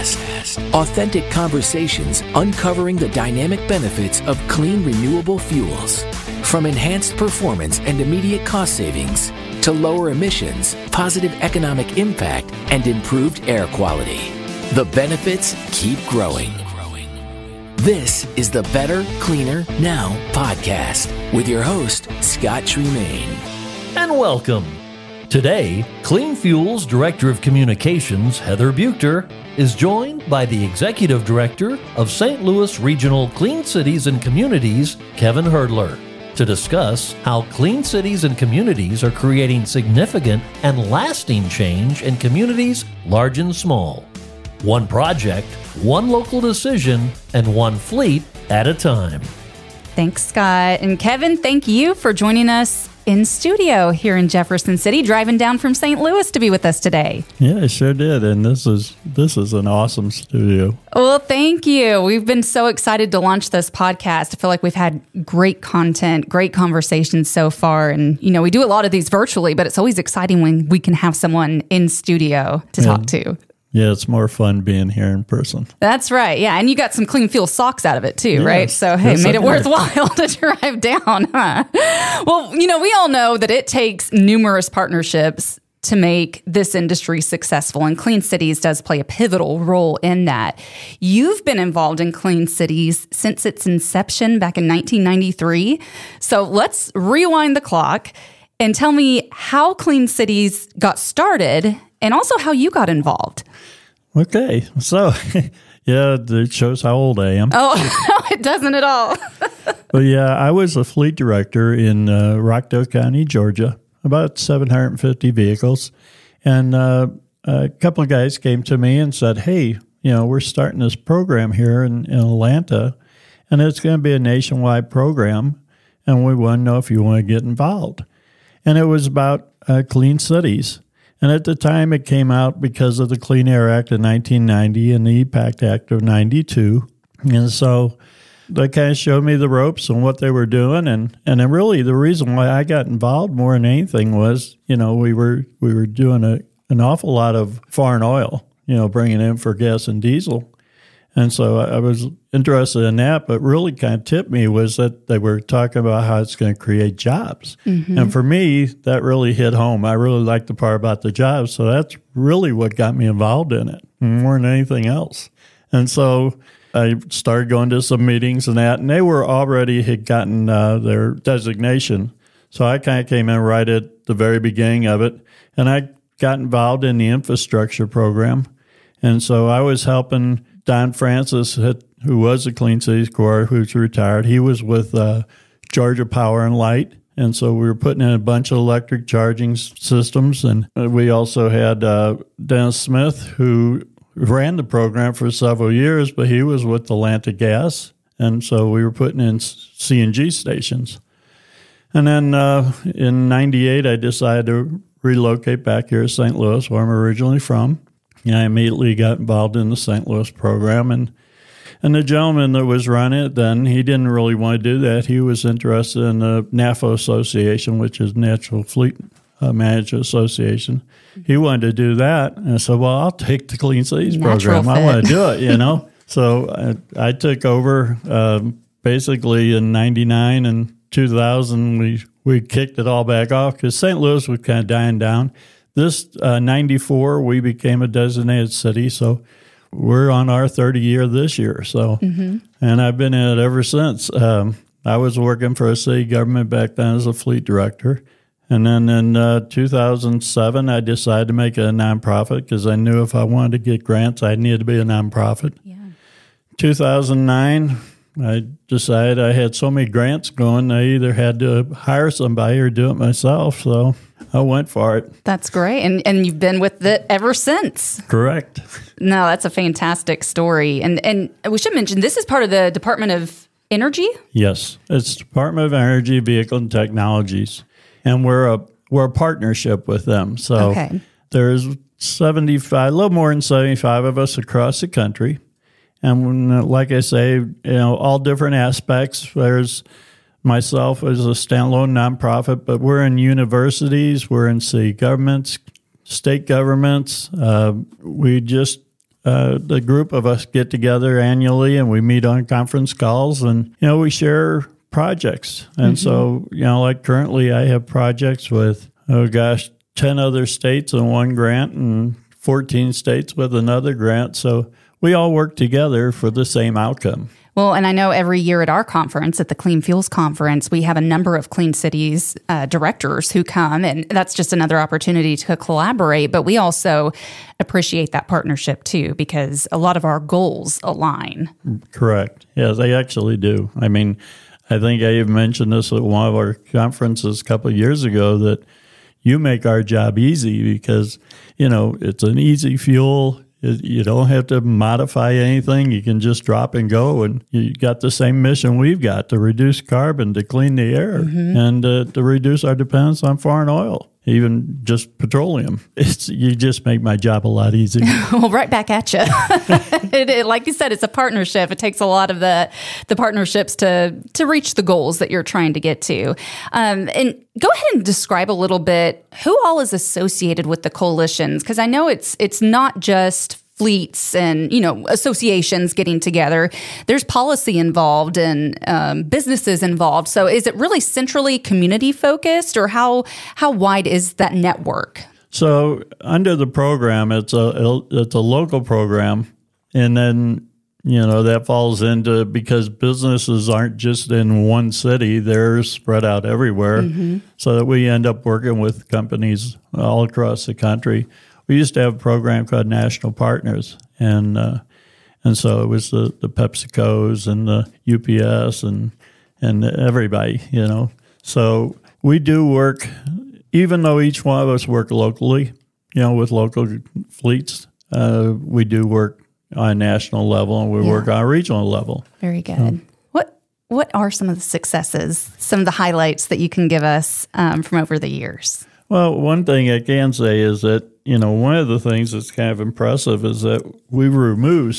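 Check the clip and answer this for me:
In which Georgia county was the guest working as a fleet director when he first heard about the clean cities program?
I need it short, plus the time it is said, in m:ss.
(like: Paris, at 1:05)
Rockdale County, at 1:52.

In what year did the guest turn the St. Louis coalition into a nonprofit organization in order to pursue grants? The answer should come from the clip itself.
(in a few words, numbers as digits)
2007.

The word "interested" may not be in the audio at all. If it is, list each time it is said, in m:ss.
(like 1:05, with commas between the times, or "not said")
2:32, 3:35.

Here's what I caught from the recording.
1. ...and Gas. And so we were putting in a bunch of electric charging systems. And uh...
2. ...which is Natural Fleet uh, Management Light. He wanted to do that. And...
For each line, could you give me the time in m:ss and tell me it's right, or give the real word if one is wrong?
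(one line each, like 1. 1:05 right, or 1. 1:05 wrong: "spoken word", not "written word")
1. 3:06 wrong: "Light", not "Gas"
2. 3:37 wrong: "Association", not "Light".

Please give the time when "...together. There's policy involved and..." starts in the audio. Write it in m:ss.
6:16.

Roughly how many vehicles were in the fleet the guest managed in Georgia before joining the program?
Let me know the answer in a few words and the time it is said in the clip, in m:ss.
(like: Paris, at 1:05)
750, at 1:54.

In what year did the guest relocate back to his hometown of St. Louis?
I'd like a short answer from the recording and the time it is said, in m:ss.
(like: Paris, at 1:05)
1998, at 3:23.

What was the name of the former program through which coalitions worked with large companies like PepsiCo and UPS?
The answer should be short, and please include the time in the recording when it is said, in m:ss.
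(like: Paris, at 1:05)
National Partners, at 6:42.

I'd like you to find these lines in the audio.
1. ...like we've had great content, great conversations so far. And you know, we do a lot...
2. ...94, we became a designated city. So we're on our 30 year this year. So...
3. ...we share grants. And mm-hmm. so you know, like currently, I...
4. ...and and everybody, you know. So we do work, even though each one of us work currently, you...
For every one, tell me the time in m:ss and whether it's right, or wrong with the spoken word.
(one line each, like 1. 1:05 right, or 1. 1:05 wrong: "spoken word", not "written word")
1. 1:04 right
2. 3:56 right
3. 5:03 wrong: "projects", not "grants"
4. 6:48 wrong: "locally", not "currently".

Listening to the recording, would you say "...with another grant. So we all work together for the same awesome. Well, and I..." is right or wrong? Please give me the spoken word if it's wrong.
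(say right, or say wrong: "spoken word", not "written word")
wrong: "outcome", not "awesome".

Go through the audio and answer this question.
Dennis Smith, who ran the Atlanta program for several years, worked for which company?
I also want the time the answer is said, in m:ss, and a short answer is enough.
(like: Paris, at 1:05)
Atlanta Gas, at 3:16.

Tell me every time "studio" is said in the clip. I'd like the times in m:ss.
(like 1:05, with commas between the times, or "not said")
0:53, 1:00, 1:11.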